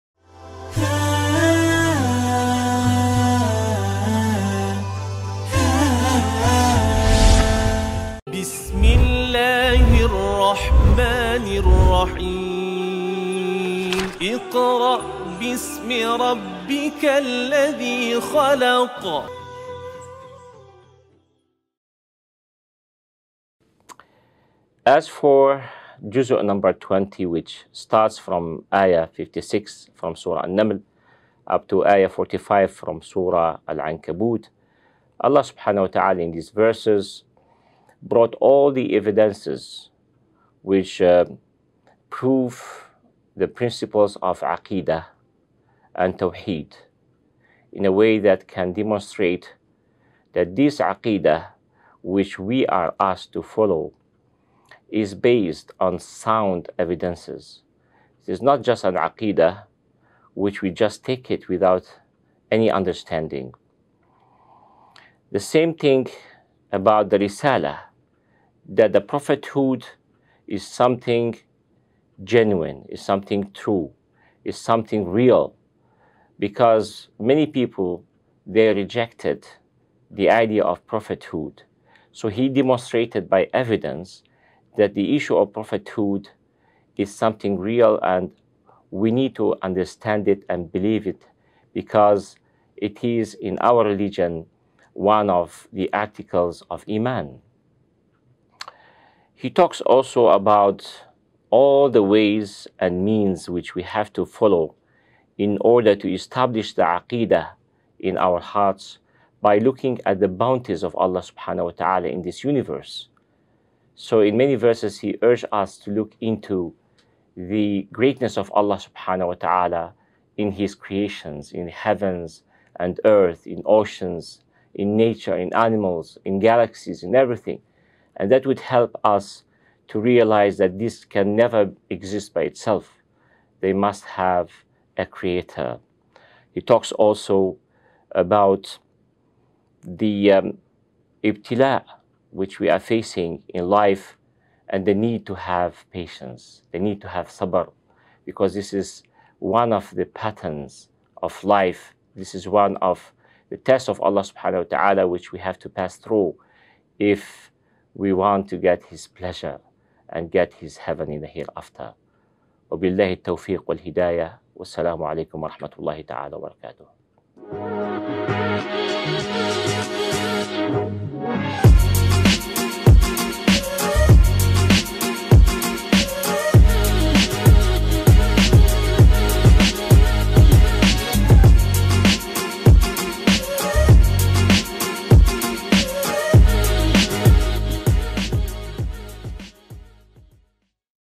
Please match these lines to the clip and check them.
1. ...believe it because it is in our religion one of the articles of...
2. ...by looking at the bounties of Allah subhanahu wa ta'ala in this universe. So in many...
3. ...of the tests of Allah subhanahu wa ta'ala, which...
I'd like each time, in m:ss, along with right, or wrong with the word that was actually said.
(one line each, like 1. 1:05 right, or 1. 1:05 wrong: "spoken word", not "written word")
1. 1:30 right
2. 1:49 right
3. 2:32 right.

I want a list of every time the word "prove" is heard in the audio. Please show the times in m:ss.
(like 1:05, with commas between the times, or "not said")
0:42.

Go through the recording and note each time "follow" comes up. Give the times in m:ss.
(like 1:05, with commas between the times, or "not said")
0:53, 1:44.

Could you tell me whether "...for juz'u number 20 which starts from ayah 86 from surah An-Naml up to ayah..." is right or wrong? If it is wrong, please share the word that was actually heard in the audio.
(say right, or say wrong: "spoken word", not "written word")
wrong: "56", not "86".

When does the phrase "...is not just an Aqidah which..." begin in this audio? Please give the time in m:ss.
0:58.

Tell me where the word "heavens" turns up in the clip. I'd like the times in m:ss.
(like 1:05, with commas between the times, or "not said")
2:01, 2:40.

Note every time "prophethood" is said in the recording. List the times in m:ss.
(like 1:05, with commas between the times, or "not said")
1:09, 1:20, 1:25.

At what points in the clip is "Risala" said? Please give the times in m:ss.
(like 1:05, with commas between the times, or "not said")
1:07.